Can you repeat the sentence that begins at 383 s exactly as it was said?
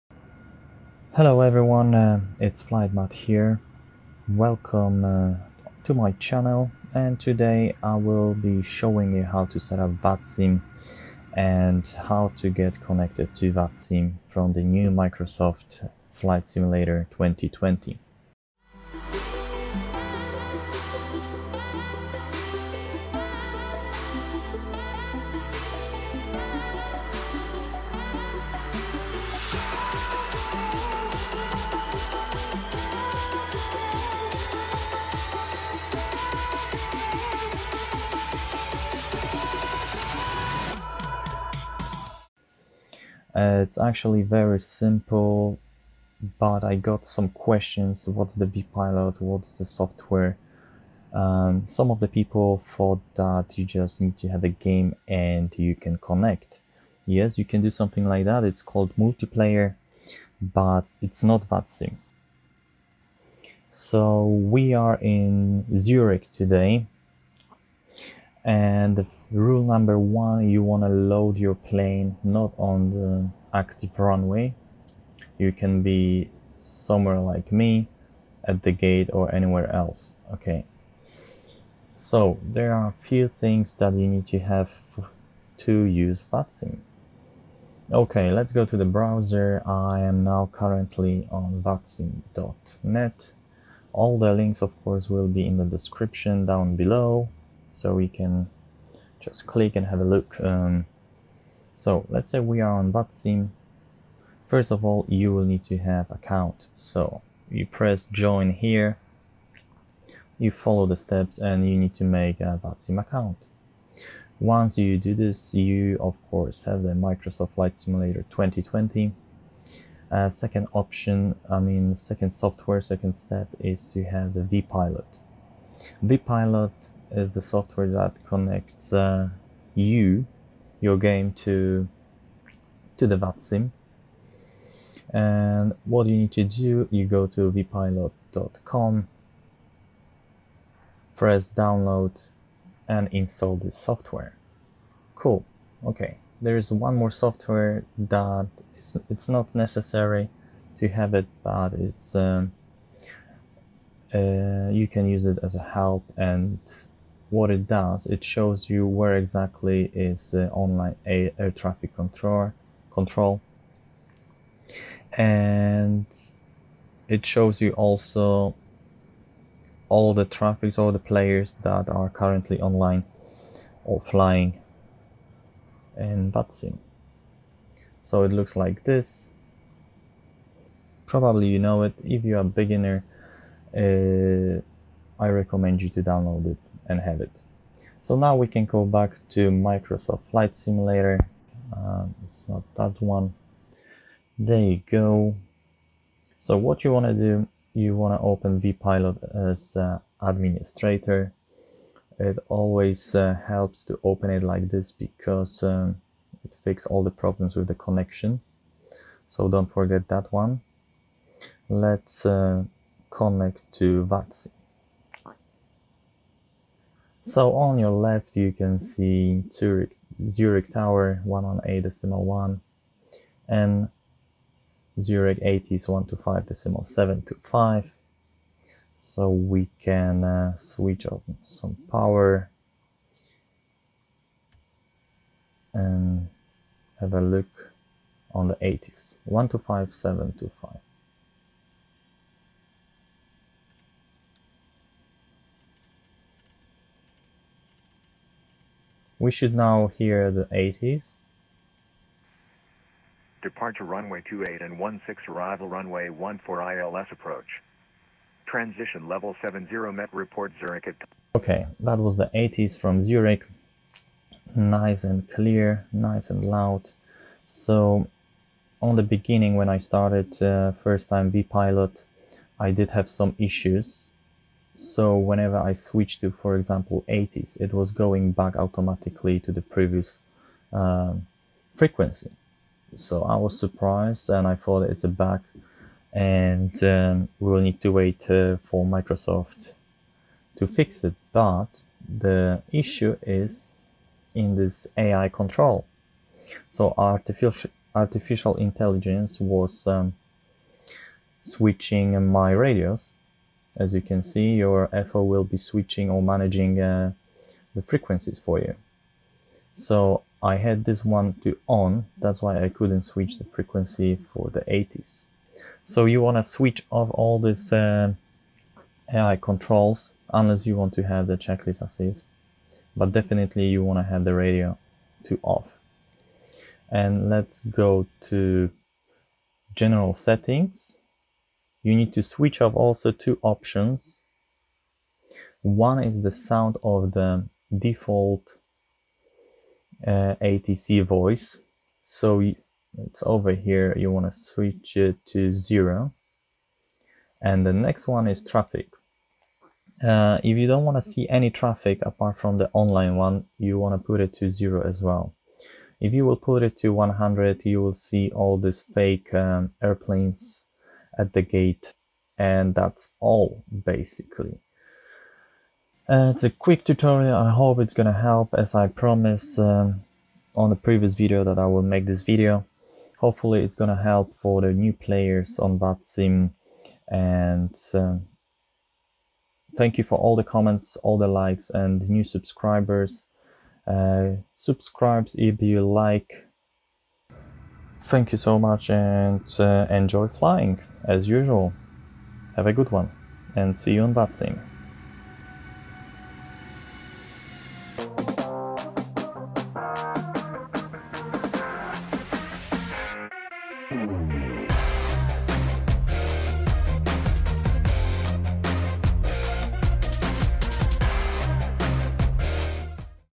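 Uh, subscribes if you like Thank you so much and uh, enjoy flying as usual.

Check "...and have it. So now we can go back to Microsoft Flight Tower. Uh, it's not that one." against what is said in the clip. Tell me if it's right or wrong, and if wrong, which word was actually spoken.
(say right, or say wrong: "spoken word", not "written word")
wrong: "Simulator", not "Tower".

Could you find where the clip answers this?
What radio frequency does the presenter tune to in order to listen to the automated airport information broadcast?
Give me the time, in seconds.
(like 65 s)
239 s.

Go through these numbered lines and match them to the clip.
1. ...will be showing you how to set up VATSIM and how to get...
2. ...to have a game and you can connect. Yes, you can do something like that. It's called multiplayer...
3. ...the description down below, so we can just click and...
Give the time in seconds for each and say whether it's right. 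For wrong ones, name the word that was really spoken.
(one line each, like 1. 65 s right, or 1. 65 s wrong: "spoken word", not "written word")
1. 7 s right
2. 54 s right
3. 95 s right.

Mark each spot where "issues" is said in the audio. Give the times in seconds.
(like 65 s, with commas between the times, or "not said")
273 s, 292 s.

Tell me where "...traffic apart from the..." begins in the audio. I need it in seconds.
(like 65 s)
351 s.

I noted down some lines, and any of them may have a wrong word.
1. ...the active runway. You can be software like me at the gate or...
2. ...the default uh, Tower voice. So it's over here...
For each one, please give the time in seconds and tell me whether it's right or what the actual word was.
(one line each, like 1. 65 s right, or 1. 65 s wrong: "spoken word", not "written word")
1. 72 s wrong: "somewhere", not "software"
2. 337 s wrong: "ATC", not "Tower".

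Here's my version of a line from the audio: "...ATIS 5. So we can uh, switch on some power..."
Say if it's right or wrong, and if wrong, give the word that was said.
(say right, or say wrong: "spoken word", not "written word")
right.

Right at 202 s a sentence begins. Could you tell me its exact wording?
It always uh, helps to open it like this because um, it fixes all the problems with the connection.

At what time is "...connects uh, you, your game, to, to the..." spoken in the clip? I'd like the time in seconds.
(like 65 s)
128 s.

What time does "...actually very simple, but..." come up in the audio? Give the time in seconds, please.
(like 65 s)
43 s.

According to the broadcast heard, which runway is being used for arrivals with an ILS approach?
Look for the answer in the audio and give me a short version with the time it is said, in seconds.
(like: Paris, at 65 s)
14, at 255 s.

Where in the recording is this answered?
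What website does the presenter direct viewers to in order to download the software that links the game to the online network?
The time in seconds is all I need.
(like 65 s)
137 s.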